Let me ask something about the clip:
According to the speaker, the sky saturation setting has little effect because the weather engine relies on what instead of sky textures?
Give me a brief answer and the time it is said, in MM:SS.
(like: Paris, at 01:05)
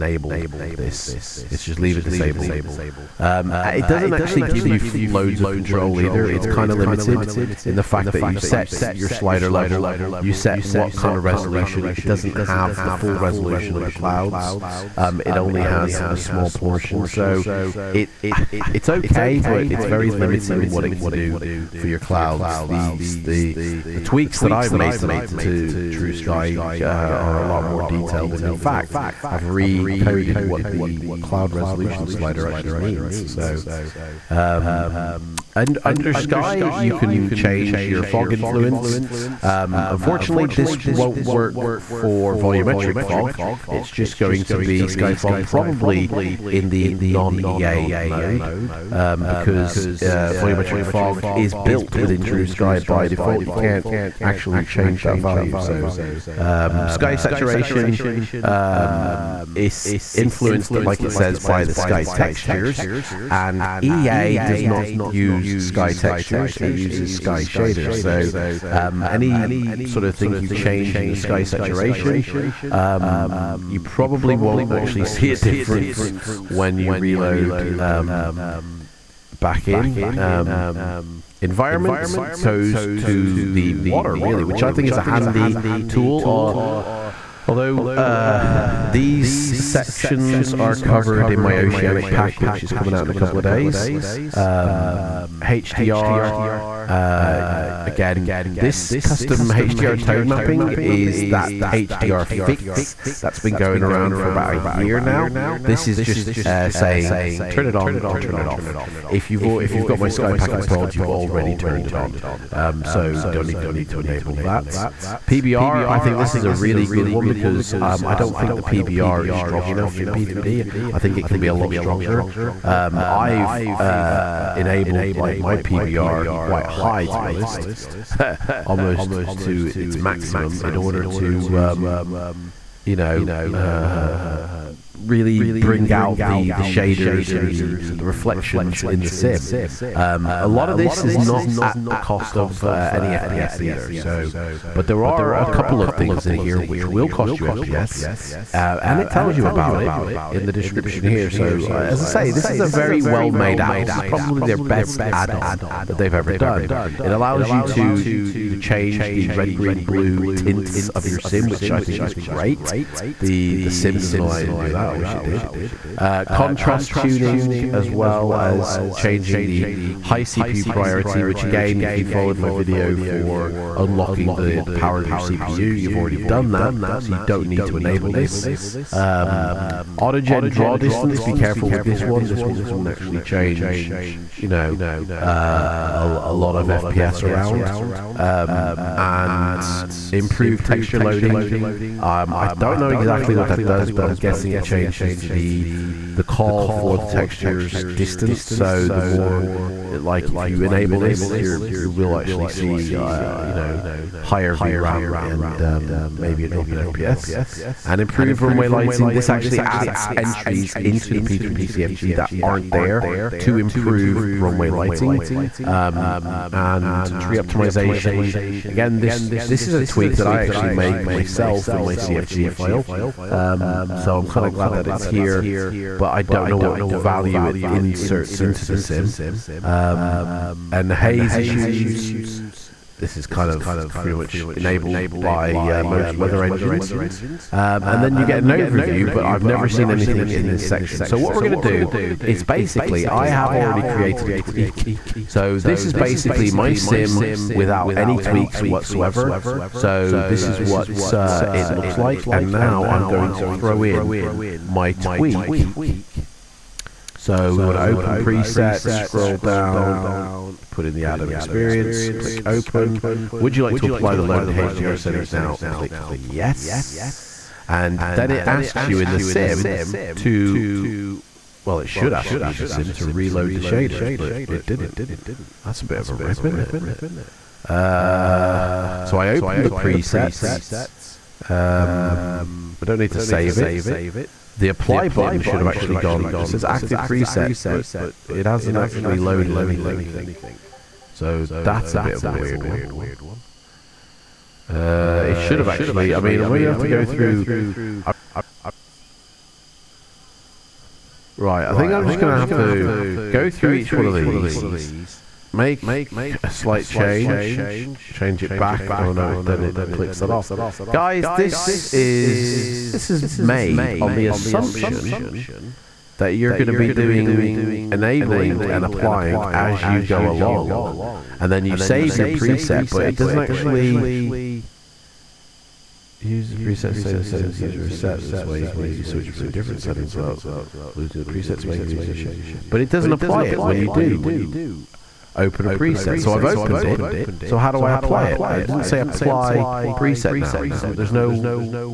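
sky shaders, at 01:07.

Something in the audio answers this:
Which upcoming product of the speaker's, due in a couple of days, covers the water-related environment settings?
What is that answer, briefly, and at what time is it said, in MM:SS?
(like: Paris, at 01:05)
oceanic pack, at 01:31.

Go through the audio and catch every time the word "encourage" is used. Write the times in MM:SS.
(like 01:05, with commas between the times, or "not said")
not said.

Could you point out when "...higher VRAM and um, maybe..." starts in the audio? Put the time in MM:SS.
03:24.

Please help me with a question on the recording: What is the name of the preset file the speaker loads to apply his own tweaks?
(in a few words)
the Adam experience.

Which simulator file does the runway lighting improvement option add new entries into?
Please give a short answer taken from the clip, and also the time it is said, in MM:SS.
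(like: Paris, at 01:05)
P3D CFG, at 03:31.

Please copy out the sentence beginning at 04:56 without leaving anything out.
I mean, maybe I have to go through.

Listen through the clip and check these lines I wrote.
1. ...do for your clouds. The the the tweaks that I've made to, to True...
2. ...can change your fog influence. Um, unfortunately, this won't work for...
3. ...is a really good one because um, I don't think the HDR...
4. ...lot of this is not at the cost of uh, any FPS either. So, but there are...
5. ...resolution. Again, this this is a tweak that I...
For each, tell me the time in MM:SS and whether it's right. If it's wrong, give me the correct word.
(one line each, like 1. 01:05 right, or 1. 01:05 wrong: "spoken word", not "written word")
1. 00:21 right
2. 00:36 right
3. 01:56 wrong: "PBR", not "HDR"
4. 02:20 right
5. 03:37 wrong: "optimization", not "resolution".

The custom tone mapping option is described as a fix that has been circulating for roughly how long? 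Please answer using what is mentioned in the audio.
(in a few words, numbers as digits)
about a year.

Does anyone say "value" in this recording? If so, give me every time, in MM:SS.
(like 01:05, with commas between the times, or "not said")
00:55, 03:46.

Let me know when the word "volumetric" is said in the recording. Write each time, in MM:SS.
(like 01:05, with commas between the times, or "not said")
00:42, 00:50.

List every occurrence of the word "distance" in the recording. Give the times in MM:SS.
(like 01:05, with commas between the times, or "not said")
03:00, 03:17.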